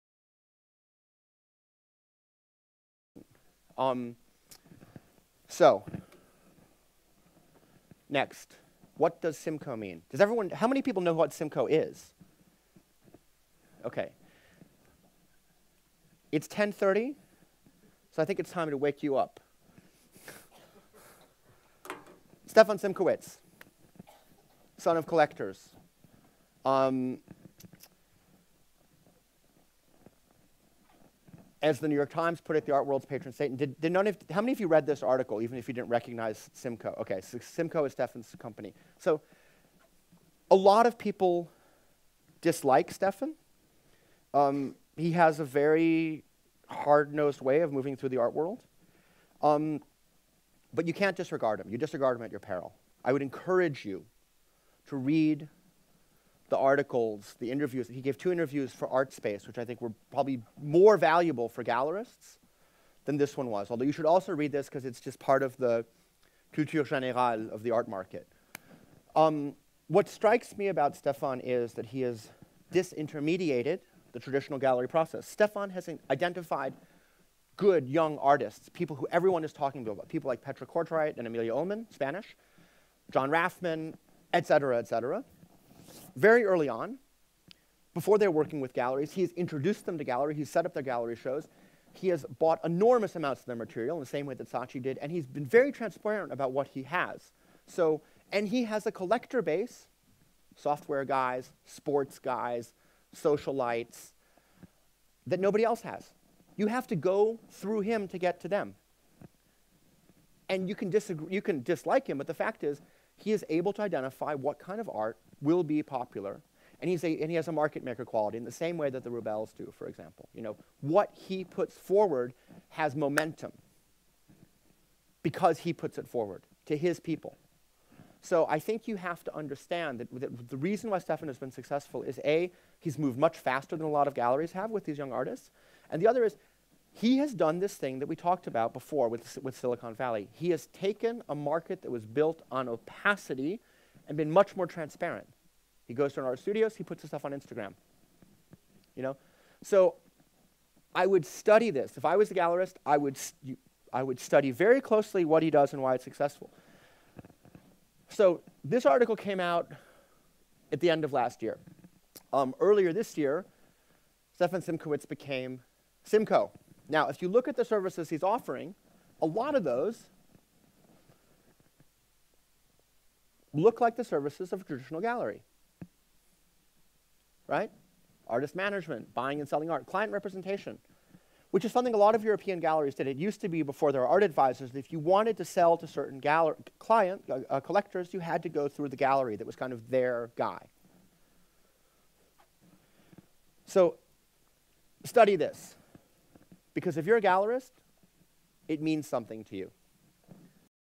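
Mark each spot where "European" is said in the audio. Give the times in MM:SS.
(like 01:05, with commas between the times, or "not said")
03:02.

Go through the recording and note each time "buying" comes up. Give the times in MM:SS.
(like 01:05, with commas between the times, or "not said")
02:59.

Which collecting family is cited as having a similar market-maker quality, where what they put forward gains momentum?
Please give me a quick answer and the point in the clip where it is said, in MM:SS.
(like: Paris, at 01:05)
The Rubells, at 01:59.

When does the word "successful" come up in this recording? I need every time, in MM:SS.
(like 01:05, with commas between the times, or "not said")
02:11, 02:36.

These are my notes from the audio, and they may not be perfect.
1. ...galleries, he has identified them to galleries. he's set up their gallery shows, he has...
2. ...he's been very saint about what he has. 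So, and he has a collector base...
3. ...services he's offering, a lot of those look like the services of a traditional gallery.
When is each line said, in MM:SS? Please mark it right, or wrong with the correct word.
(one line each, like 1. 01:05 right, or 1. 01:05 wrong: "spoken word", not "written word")
1. 01:28 wrong: "introduced", not "identified"
2. 01:35 wrong: "transparent", not "saint"
3. 02:47 right.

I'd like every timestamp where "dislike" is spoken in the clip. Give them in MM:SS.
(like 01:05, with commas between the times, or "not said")
00:42, 01:51.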